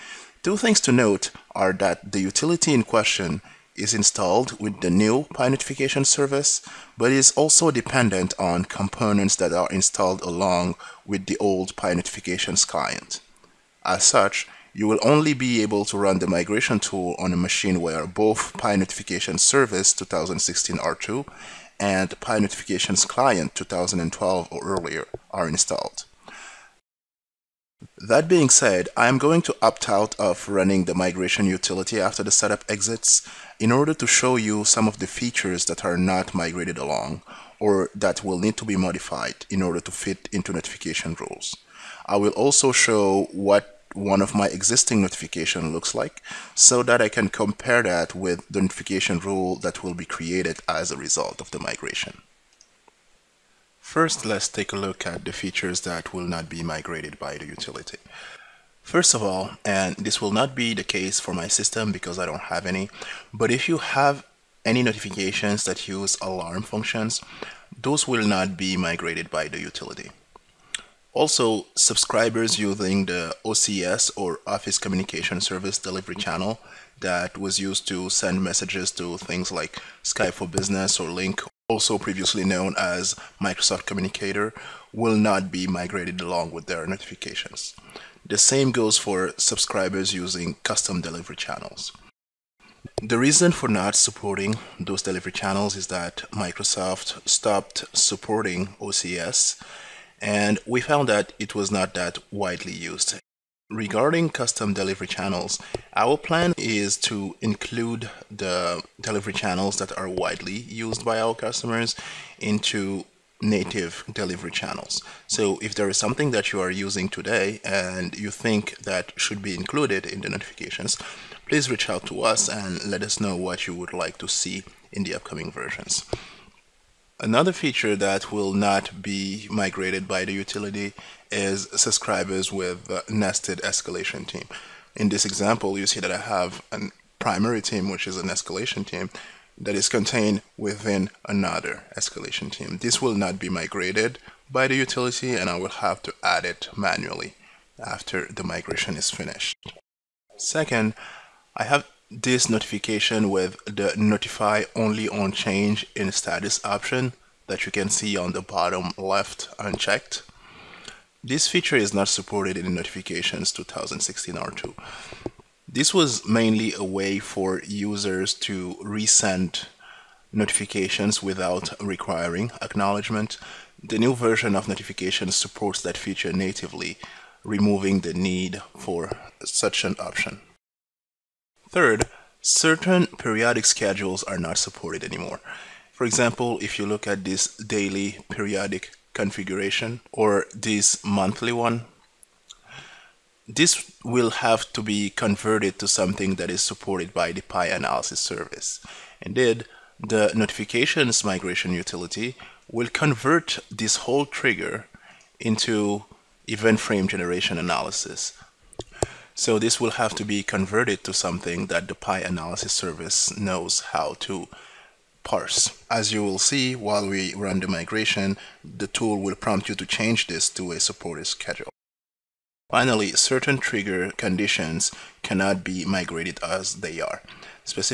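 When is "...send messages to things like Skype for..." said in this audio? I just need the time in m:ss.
1:18.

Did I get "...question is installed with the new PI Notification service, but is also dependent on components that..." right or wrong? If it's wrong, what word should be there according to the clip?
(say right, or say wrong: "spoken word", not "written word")
right.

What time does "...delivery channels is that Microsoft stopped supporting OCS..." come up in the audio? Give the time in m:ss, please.
1:35.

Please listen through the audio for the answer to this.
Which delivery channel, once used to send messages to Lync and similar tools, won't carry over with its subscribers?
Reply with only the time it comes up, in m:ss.
1:14.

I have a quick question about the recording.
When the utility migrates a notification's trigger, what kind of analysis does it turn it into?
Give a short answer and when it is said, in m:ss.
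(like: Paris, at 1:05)
event frame generation, at 3:26.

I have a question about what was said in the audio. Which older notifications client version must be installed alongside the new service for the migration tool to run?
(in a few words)
PI Notifications Client 2012.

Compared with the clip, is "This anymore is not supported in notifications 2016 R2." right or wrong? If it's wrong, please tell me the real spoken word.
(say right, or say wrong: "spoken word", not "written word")
wrong: "feature", not "anymore".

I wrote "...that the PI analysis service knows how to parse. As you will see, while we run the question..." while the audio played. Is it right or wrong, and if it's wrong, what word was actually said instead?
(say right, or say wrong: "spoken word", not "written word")
wrong: "migration", not "question".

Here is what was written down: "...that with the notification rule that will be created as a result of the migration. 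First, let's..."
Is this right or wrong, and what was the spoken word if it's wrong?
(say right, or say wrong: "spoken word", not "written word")
right.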